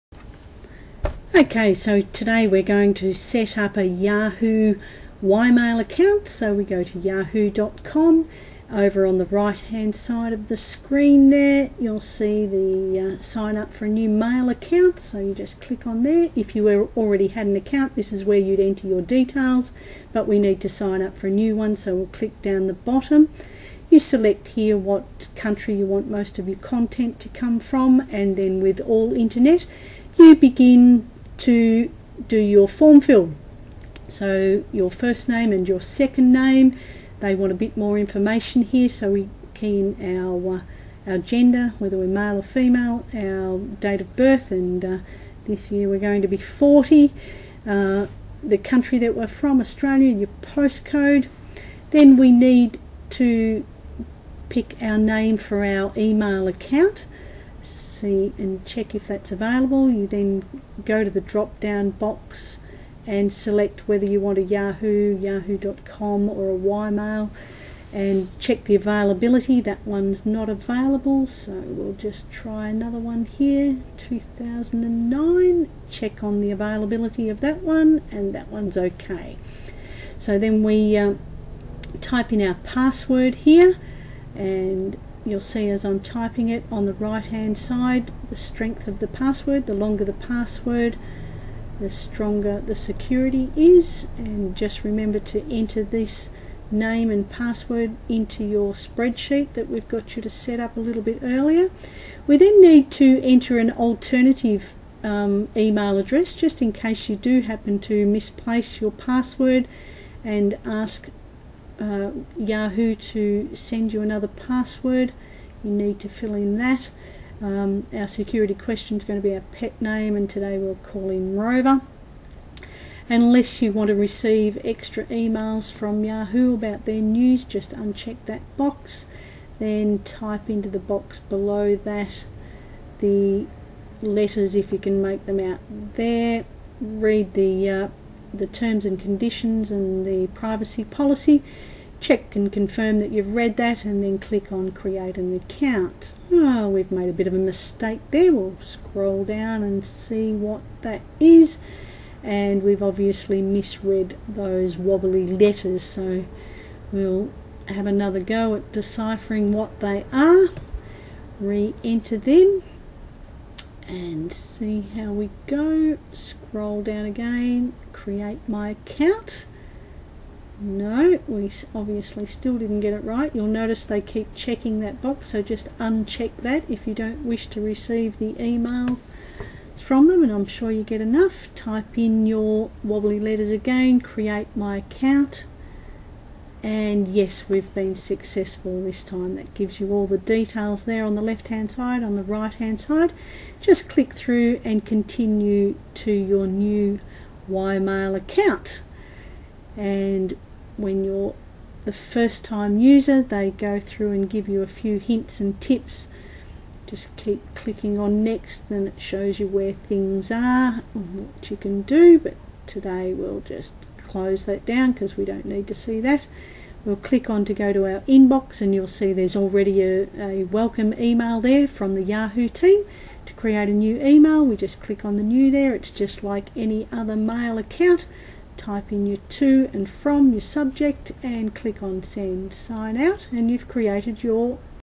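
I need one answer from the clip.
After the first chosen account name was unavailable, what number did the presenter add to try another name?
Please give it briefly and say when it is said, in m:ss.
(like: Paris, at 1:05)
2009, at 1:13.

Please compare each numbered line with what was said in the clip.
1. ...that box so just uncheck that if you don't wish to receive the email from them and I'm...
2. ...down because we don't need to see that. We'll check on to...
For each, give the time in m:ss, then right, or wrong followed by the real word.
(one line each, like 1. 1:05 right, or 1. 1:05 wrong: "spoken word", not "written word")
1. 2:54 right
2. 3:34 wrong: "click", not "check".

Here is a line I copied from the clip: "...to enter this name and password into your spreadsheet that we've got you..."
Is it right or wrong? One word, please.
right.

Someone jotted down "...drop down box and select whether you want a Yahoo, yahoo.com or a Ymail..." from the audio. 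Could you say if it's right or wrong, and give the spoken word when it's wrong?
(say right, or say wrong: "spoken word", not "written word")
right.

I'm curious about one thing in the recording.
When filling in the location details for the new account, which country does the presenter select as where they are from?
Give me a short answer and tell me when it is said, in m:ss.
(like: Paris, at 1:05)
Australia, at 0:49.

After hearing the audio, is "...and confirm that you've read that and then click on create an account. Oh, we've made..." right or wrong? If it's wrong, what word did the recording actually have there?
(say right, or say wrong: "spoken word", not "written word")
right.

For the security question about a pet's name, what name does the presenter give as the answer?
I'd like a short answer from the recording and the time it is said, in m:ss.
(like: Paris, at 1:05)
Rover, at 2:01.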